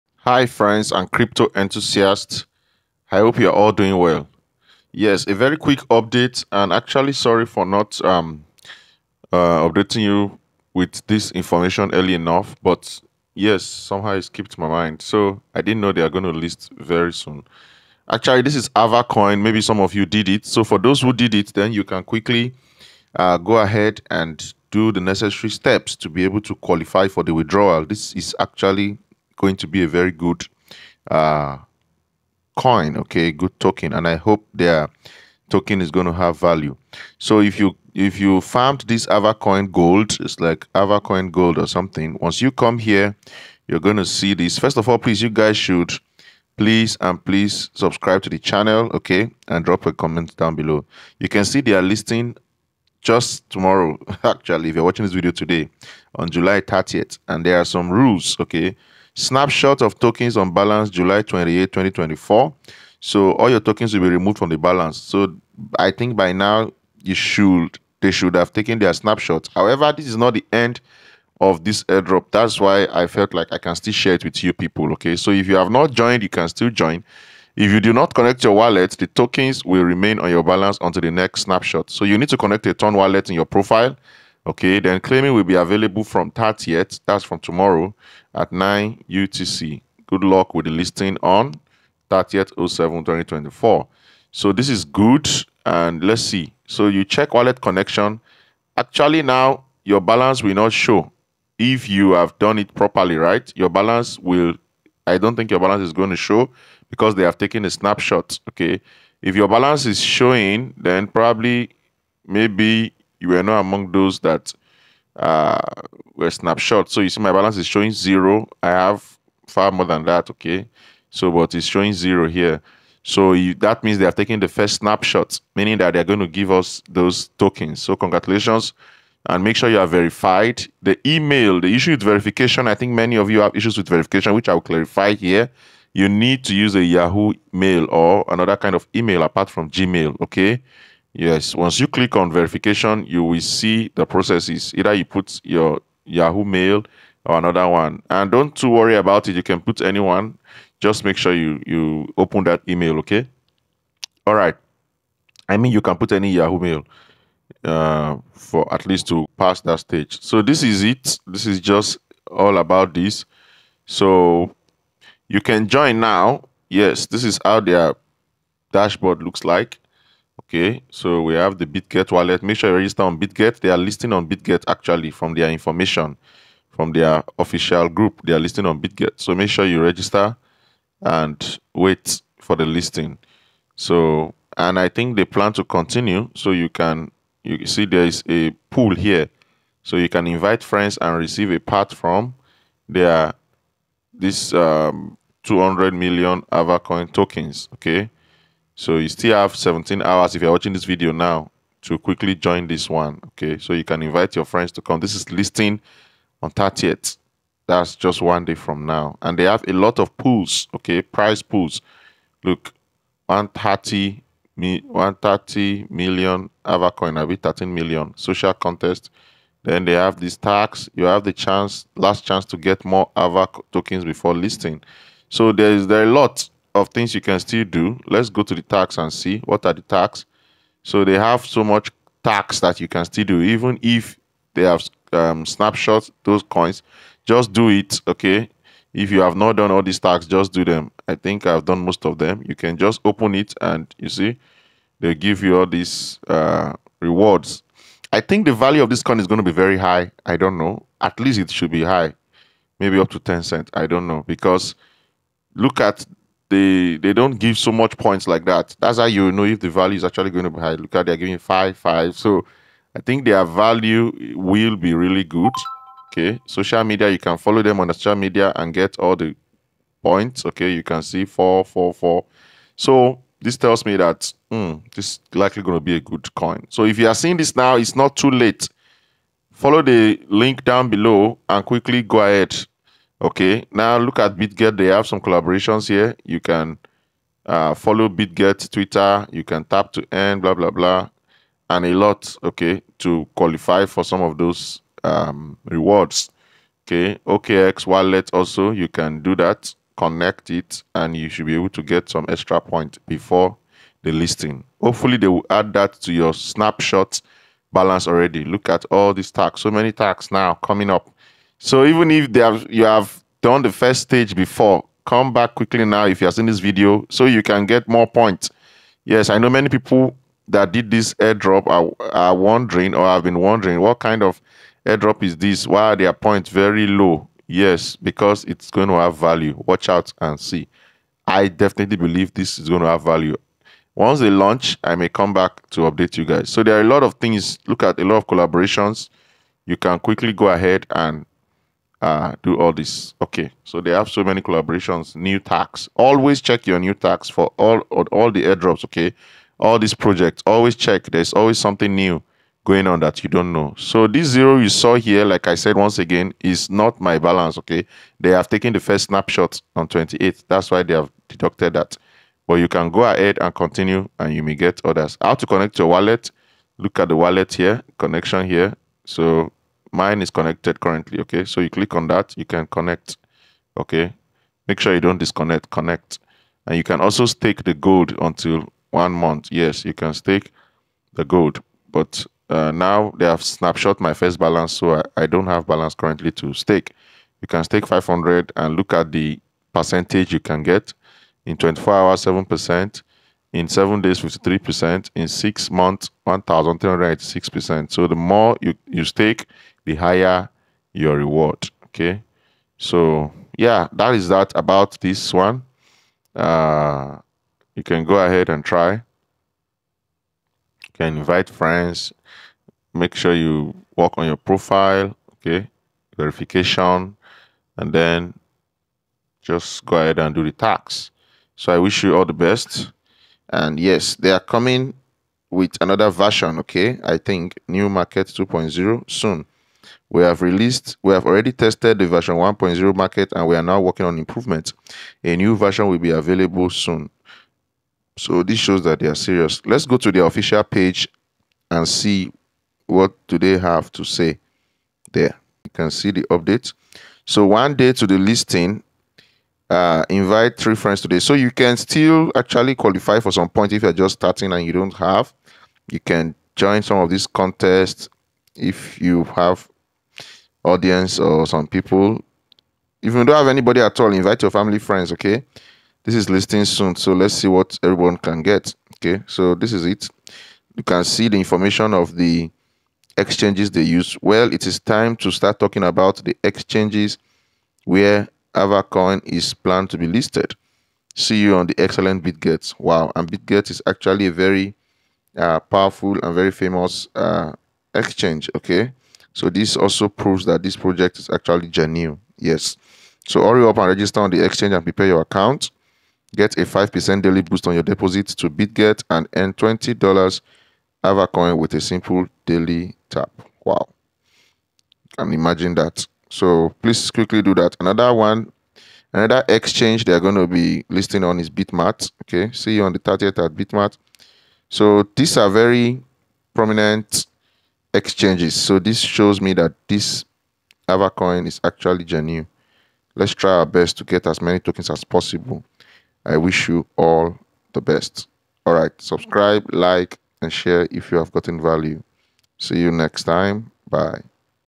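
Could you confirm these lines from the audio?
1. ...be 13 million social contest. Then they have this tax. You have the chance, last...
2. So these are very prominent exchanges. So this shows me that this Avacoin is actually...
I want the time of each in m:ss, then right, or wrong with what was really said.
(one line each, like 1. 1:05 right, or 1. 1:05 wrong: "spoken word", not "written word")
1. 3:37 right
2. 8:34 right.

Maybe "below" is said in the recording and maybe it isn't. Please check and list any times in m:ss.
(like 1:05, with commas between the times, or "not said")
0:50, 4:40.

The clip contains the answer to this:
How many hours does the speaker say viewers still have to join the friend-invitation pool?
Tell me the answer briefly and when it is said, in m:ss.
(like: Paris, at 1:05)
17, at 3:19.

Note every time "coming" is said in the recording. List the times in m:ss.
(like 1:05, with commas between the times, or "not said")
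5:10, 7:04.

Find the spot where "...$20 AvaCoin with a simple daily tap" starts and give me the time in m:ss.
8:19.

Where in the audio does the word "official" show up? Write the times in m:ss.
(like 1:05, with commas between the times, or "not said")
2:57, 7:20.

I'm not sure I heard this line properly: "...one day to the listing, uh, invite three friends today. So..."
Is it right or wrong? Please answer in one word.
right.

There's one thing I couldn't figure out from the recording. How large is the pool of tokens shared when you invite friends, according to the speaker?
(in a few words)
200 million.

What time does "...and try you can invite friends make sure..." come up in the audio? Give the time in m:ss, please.
6:48.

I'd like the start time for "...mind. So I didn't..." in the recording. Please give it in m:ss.
0:14.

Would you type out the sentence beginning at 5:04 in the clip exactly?
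Hopefully, they will add that to your snapshot balance already.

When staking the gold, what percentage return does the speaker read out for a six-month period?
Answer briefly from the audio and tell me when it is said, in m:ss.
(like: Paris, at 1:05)
1386%, at 6:36.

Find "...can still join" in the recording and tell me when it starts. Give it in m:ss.
1:16.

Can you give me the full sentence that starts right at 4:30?
Okay, you can see four, four, four.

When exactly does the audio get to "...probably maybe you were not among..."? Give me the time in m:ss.
1:51.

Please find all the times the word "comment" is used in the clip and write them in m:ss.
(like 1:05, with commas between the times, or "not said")
0:49.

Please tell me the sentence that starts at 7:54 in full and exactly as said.
Well, it is time to start talking about the exchanges where AvaCoin is planned to be listed.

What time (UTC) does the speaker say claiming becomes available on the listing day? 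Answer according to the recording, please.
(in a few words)
9 UTC.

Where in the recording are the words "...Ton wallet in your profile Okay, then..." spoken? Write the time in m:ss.
1:22.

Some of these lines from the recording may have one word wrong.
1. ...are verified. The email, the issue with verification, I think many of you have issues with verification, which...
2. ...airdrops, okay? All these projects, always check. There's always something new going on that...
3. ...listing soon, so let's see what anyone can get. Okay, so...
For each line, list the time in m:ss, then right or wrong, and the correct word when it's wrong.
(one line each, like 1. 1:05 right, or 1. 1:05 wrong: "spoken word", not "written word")
1. 2:09 right
2. 5:48 right
3. 7:46 wrong: "everyone", not "anyone".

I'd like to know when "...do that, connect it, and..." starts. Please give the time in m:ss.
4:59.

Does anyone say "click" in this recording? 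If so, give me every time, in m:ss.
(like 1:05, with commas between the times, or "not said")
2:21, 6:11.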